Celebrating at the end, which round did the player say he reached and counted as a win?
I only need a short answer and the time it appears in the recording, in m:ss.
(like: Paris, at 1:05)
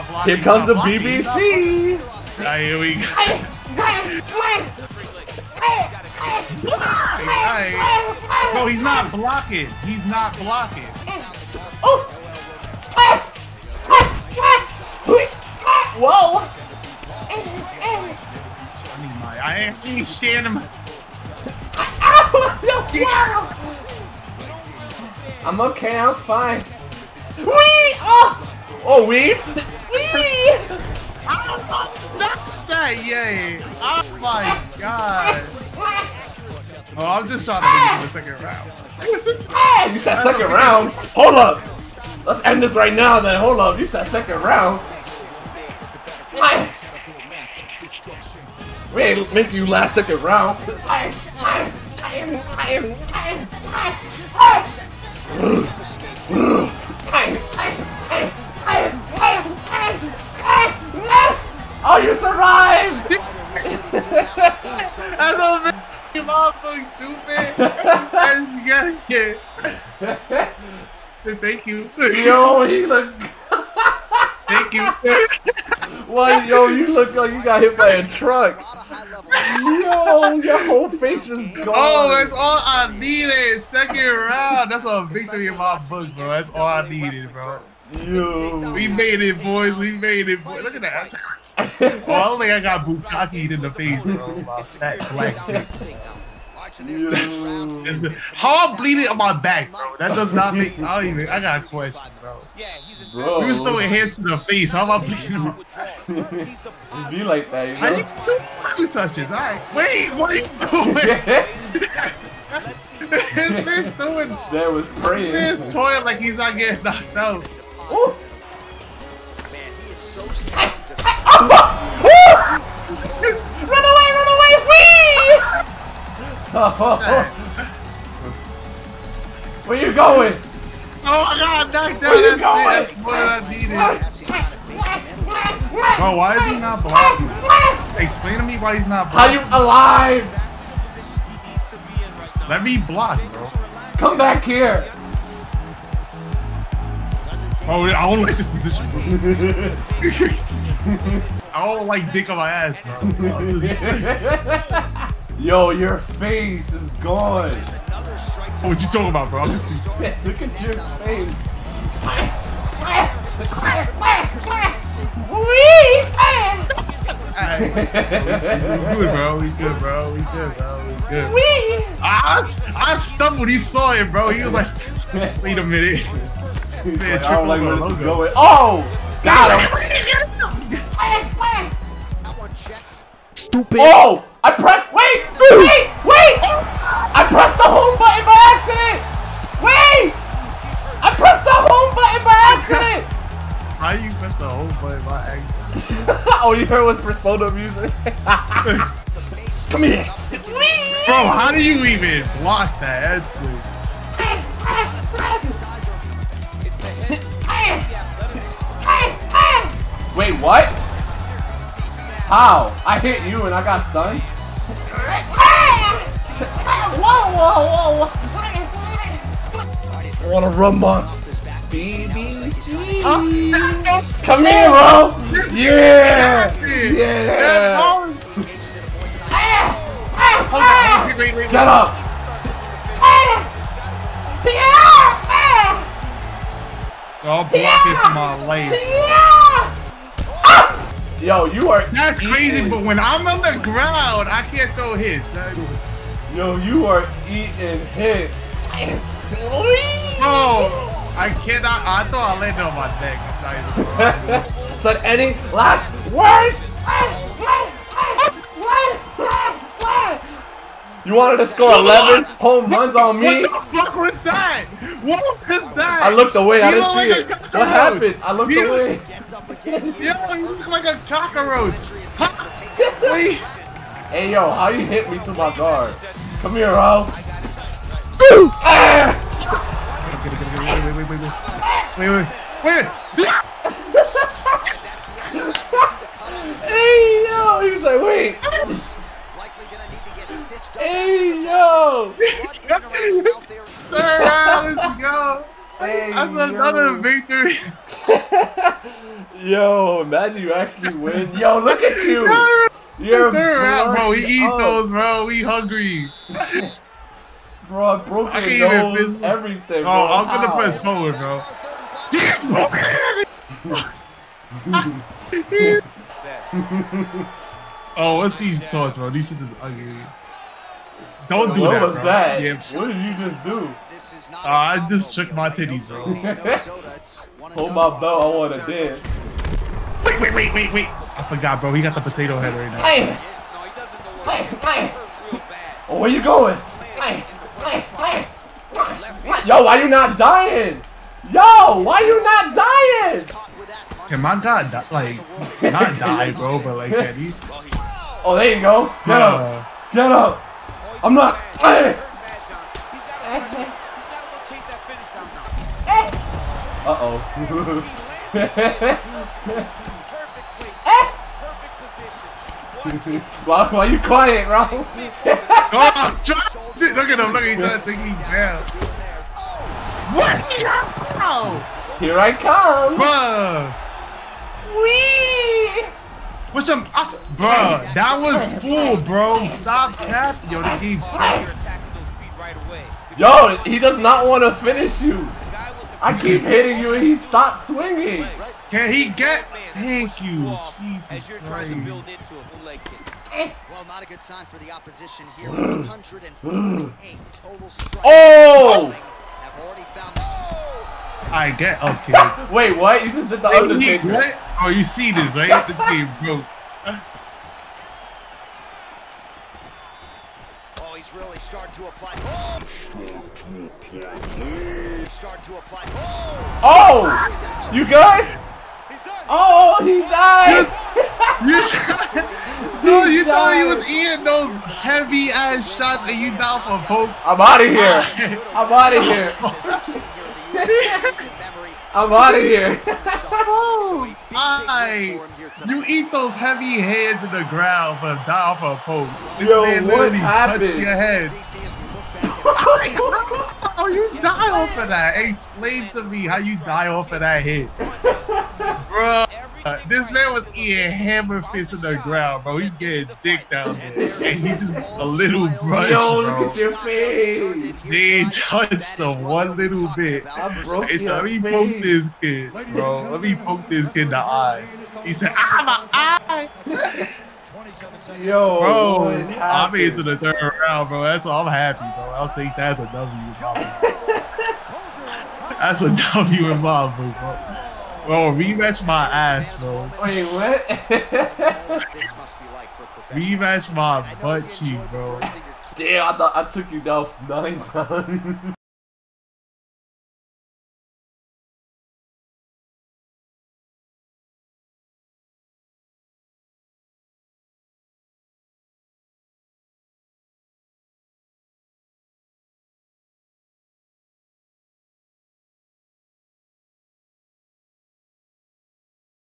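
third round, at 7:50.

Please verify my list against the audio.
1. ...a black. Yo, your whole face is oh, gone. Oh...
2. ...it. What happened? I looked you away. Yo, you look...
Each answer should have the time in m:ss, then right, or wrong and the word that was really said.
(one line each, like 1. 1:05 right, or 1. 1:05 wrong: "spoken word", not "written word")
1. 1:17 wrong: "truck", not "black"
2. 4:27 right.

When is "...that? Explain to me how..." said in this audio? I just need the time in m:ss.
7:24.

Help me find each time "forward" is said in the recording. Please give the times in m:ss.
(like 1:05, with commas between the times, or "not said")
5:10.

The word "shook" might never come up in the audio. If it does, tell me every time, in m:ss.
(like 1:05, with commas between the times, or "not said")
5:25.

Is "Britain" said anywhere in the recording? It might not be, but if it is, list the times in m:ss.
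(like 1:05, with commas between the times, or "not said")
not said.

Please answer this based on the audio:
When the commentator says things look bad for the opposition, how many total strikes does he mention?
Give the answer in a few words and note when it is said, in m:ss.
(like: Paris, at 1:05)
148, at 6:35.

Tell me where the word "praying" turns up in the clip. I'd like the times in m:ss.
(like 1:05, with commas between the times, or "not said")
1:54.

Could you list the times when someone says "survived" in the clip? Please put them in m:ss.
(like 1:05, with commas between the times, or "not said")
1:02.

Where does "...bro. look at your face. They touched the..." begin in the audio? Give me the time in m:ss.
7:36.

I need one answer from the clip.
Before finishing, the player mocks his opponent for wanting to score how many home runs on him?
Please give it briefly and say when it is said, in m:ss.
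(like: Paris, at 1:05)
11, at 4:21.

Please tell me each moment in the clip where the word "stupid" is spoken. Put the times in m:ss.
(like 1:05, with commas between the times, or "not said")
1:06, 3:03.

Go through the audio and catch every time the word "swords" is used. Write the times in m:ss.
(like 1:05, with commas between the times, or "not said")
5:18.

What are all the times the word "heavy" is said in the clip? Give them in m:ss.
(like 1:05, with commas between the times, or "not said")
7:04, 7:16.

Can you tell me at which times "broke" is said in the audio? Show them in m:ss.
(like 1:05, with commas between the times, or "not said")
5:08, 6:46.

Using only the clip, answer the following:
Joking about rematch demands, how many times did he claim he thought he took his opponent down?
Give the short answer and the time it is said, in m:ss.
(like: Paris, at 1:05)
9, at 8:07.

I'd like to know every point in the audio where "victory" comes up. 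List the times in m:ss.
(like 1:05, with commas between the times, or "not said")
1:25, 4:56.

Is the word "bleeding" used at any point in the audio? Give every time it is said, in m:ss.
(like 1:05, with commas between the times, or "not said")
1:38, 1:44.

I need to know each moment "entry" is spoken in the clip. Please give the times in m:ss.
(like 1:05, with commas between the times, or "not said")
not said.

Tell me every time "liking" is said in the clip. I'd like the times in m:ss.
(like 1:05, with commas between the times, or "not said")
not said.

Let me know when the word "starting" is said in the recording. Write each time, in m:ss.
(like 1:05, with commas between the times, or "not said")
6:51.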